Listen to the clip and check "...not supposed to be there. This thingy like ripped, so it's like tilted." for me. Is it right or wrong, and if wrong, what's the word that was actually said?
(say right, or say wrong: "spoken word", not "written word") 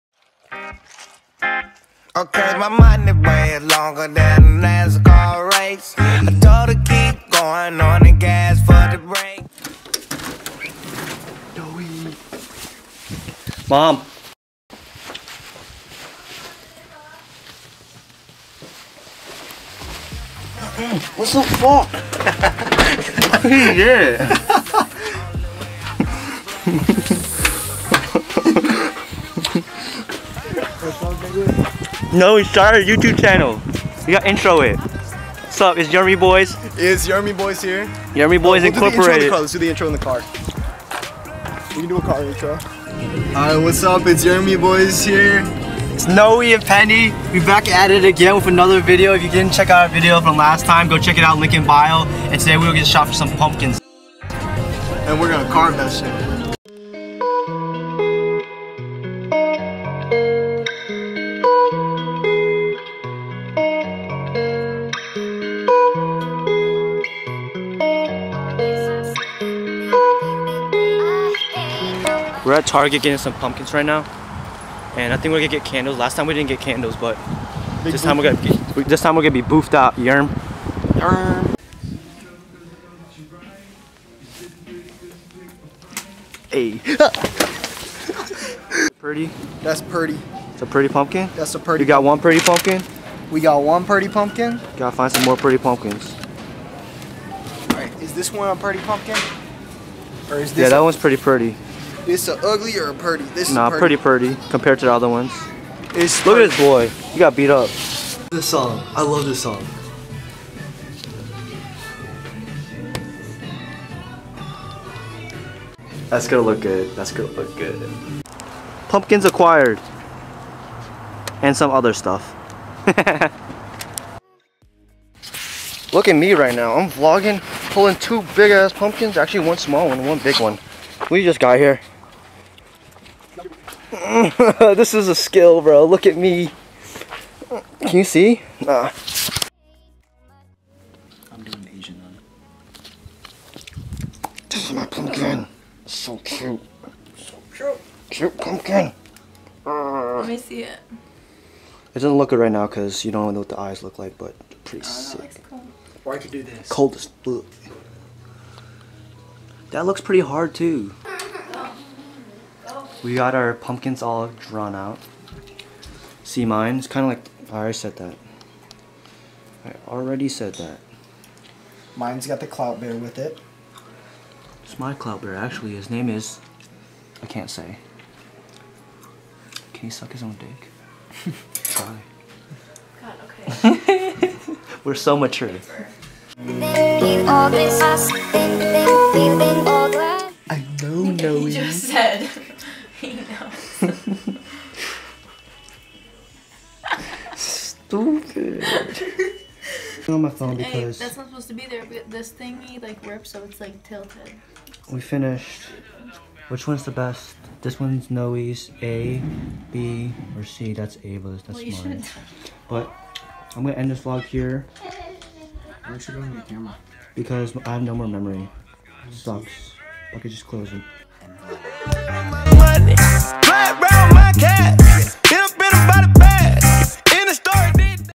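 right.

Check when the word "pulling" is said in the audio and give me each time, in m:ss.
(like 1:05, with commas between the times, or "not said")
2:07.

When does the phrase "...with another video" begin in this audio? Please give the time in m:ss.
0:48.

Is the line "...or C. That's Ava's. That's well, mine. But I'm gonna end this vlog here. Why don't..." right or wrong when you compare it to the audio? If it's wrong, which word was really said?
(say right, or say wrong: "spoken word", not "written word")
right.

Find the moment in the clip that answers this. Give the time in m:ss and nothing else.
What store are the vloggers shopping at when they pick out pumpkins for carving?
1:12.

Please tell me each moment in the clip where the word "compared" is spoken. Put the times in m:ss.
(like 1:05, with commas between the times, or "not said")
1:44.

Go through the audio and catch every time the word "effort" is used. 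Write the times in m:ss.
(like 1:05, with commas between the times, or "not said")
not said.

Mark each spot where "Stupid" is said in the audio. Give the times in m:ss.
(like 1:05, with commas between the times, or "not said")
3:17.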